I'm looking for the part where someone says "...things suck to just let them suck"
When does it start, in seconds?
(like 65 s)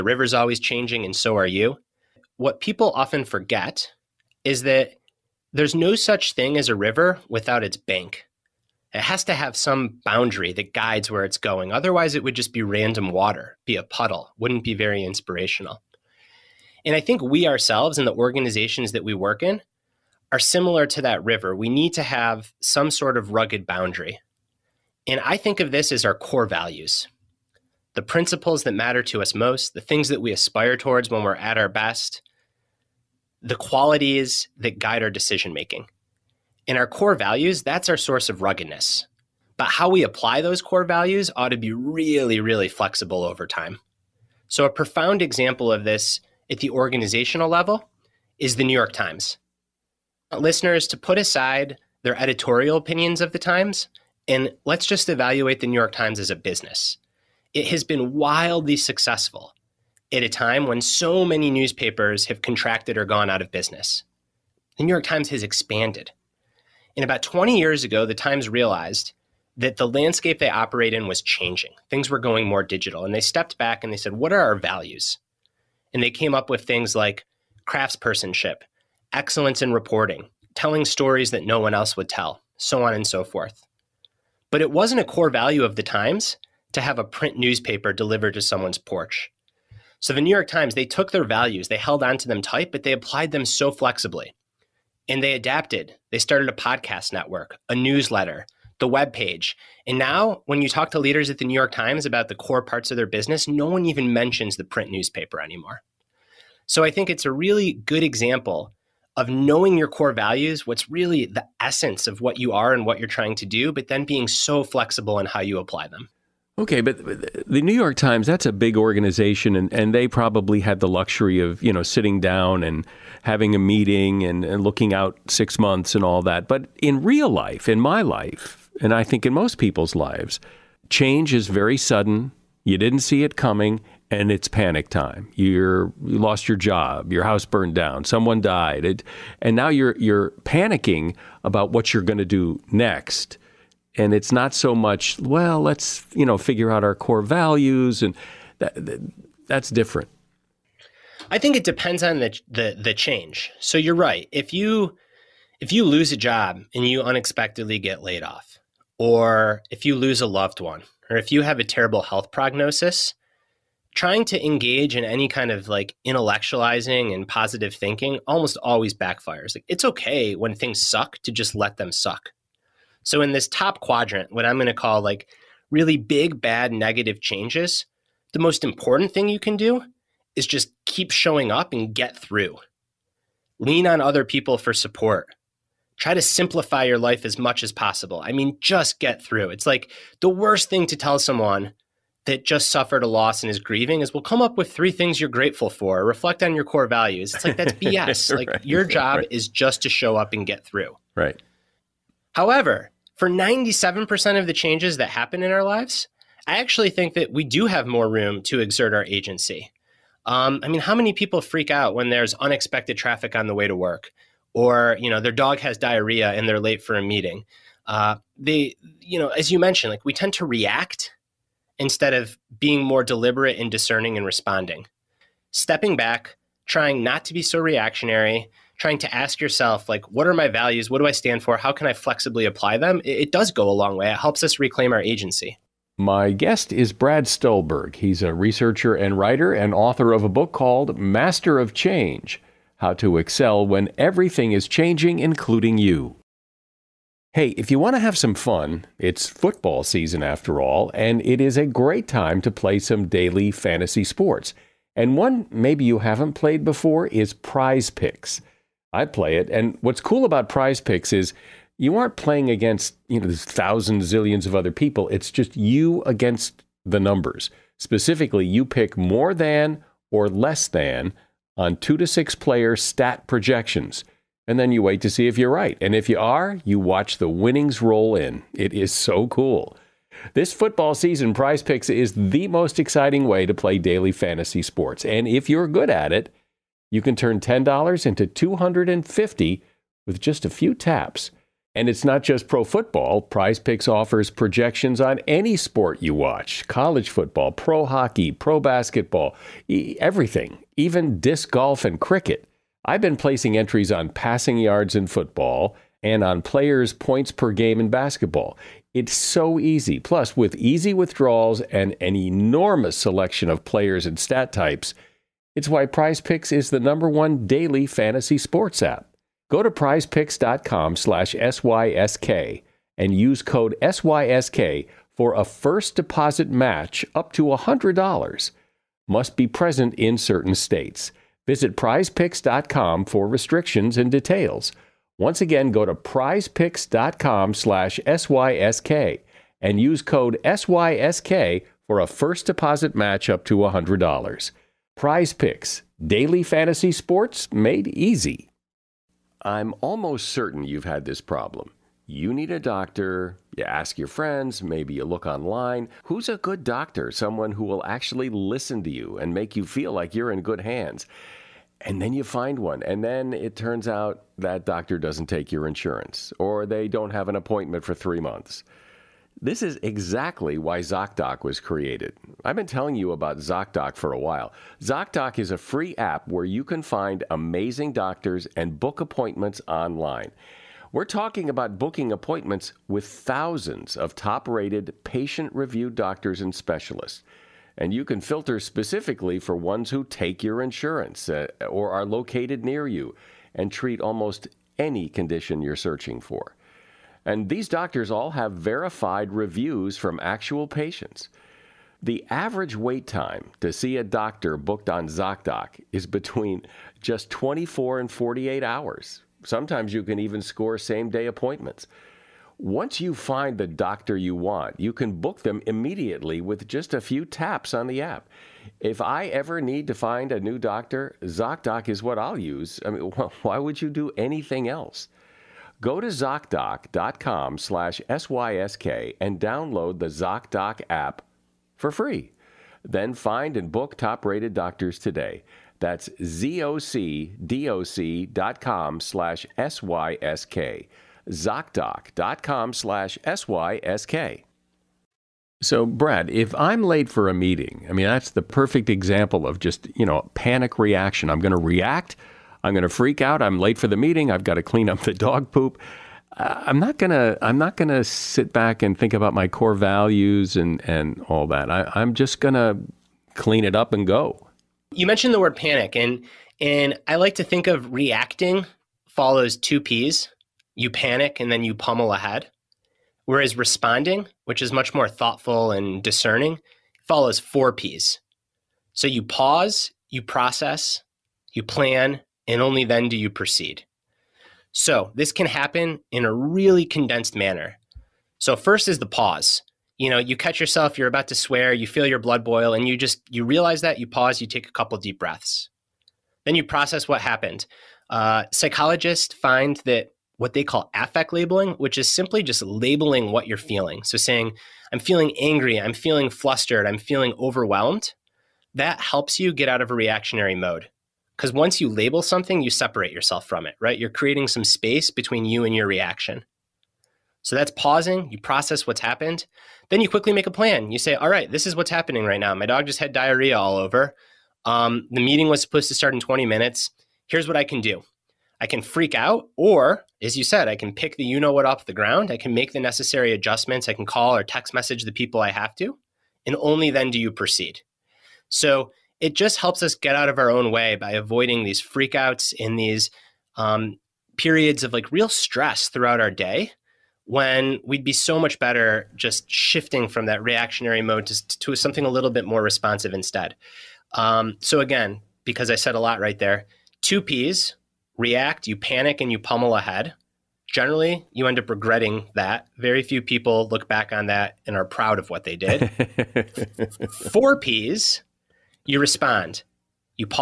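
170 s.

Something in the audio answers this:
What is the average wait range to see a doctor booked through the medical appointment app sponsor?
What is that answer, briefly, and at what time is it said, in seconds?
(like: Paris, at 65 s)
24 and 48 hours, at 407 s.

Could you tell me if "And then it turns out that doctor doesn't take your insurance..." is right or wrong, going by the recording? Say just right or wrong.
right.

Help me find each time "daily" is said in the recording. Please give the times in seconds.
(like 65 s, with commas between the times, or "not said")
253 s, 283 s, 317 s, 346 s.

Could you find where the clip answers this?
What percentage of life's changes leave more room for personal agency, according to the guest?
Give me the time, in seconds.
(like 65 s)
203 s.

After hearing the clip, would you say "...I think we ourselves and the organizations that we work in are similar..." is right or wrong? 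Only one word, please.
right.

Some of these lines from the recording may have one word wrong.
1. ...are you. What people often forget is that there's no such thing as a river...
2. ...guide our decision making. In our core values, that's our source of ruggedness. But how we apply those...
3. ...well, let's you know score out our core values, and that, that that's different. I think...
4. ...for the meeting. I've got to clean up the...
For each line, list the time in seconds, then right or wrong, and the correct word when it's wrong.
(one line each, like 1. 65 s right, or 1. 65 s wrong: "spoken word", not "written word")
1. 1 s right
2. 34 s right
3. 145 s wrong: "figure", not "score"
4. 453 s right.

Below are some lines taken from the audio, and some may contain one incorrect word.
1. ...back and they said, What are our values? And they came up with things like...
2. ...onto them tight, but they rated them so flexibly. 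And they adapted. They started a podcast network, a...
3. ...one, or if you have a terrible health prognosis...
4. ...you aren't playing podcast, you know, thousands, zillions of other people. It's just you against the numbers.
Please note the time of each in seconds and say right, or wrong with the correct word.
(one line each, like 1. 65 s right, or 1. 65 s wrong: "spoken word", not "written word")
1. 73 s right
2. 92 s wrong: "applied", not "rated"
3. 160 s right
4. 261 s wrong: "against", not "podcast".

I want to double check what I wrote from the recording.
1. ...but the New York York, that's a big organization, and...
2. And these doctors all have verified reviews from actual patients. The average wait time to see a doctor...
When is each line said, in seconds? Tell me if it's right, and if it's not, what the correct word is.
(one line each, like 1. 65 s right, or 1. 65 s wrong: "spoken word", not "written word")
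1. 116 s wrong: "Times", not "York"
2. 397 s right.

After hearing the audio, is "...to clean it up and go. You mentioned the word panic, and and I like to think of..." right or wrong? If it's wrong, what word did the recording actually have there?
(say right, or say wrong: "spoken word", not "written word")
right.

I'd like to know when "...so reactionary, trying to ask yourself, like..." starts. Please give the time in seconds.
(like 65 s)
227 s.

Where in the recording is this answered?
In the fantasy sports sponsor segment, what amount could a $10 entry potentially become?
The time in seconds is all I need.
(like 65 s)
288 s.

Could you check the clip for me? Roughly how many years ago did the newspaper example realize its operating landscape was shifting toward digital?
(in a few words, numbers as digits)
20 years.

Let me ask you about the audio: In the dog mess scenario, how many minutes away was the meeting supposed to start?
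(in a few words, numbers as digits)
20 minutes.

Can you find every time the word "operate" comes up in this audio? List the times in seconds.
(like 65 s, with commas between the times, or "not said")
70 s.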